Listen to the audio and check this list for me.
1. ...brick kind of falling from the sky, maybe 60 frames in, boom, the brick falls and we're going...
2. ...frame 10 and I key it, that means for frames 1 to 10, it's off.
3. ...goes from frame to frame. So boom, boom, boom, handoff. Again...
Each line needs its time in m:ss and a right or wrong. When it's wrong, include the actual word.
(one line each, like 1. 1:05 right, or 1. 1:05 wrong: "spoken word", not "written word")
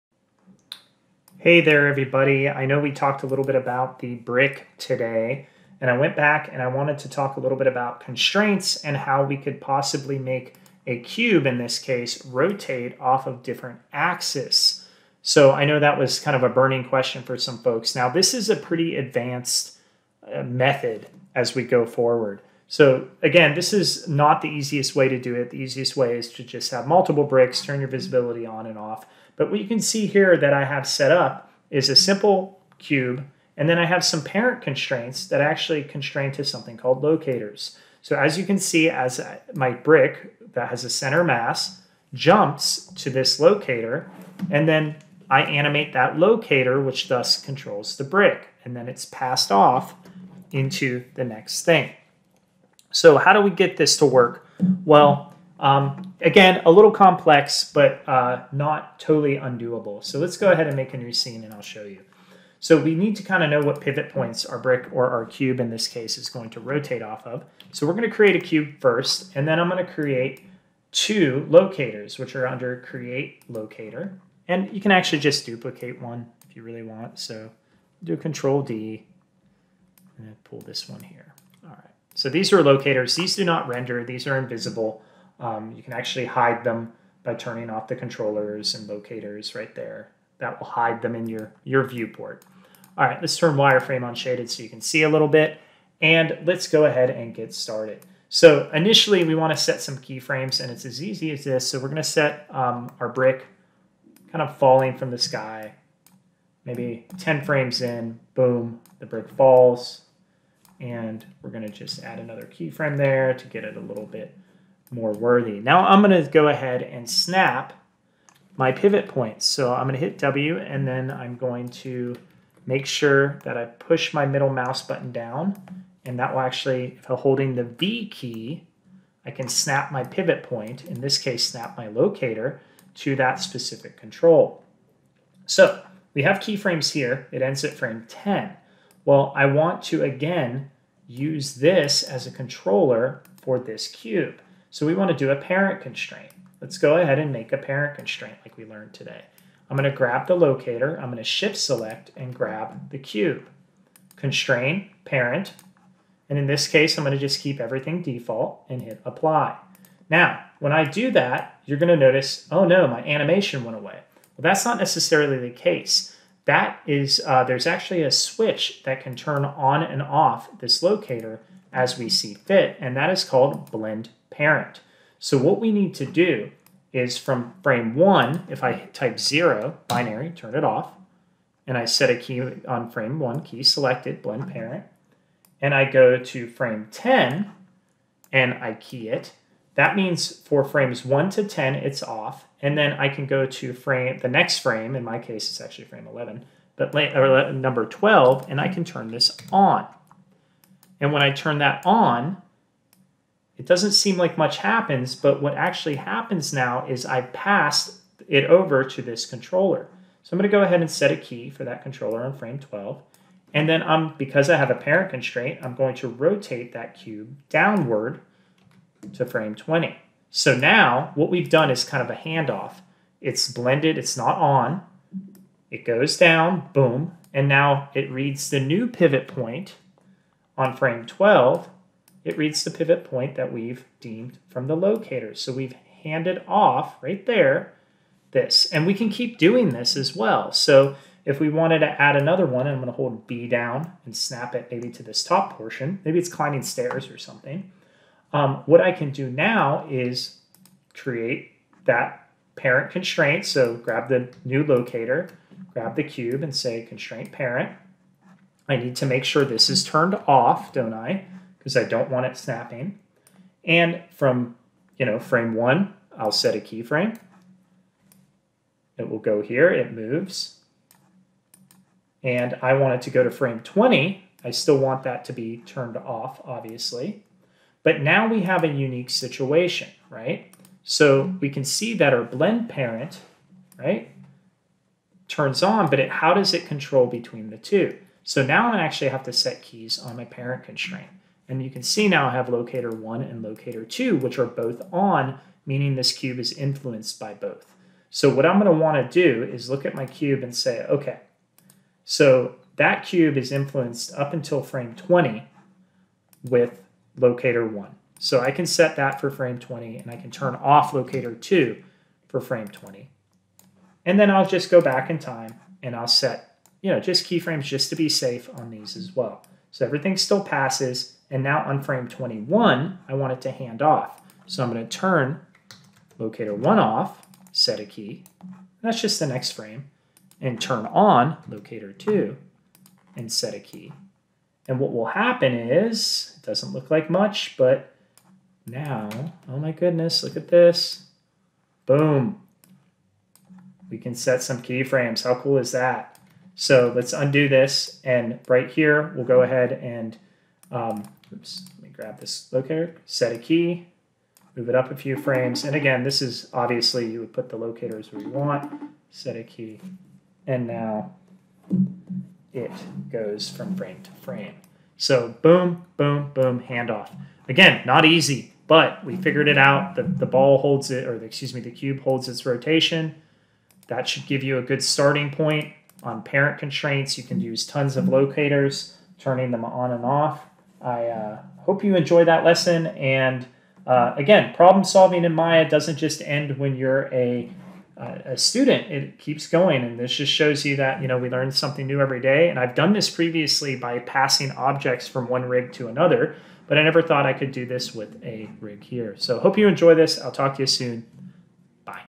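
1. 1:43 wrong: "10", not "60"
2. 3:06 right
3. 6:03 right.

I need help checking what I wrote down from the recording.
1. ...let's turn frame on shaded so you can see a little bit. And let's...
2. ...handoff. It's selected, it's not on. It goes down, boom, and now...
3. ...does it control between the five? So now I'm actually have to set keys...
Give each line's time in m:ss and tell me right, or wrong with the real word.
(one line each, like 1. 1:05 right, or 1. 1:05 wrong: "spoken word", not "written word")
1. 1:33 wrong: "wireframe", not "frame"
2. 3:42 wrong: "blended", not "selected"
3. 4:46 wrong: "two", not "five".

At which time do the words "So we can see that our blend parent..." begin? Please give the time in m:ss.
4:40.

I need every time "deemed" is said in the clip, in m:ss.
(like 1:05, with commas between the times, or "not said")
3:53.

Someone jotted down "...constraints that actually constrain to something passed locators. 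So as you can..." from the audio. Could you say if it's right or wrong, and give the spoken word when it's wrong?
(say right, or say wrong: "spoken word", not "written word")
wrong: "called", not "passed".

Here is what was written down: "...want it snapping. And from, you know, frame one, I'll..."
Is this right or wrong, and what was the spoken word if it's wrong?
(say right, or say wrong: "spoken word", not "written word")
right.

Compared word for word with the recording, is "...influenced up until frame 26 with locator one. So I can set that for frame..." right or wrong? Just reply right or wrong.
wrong.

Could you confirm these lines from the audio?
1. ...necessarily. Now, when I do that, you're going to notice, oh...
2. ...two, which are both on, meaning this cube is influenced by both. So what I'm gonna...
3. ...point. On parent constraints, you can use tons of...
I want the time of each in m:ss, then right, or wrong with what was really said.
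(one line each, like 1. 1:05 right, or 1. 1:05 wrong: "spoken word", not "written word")
1. 2:39 wrong: "apply", not "necessarily"
2. 4:53 right
3. 6:15 right.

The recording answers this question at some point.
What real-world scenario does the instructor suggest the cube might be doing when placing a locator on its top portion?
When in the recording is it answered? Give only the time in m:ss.
4:06.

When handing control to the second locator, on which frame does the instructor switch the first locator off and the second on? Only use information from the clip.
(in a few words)
21.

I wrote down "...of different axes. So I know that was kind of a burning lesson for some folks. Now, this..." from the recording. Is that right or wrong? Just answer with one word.
wrong.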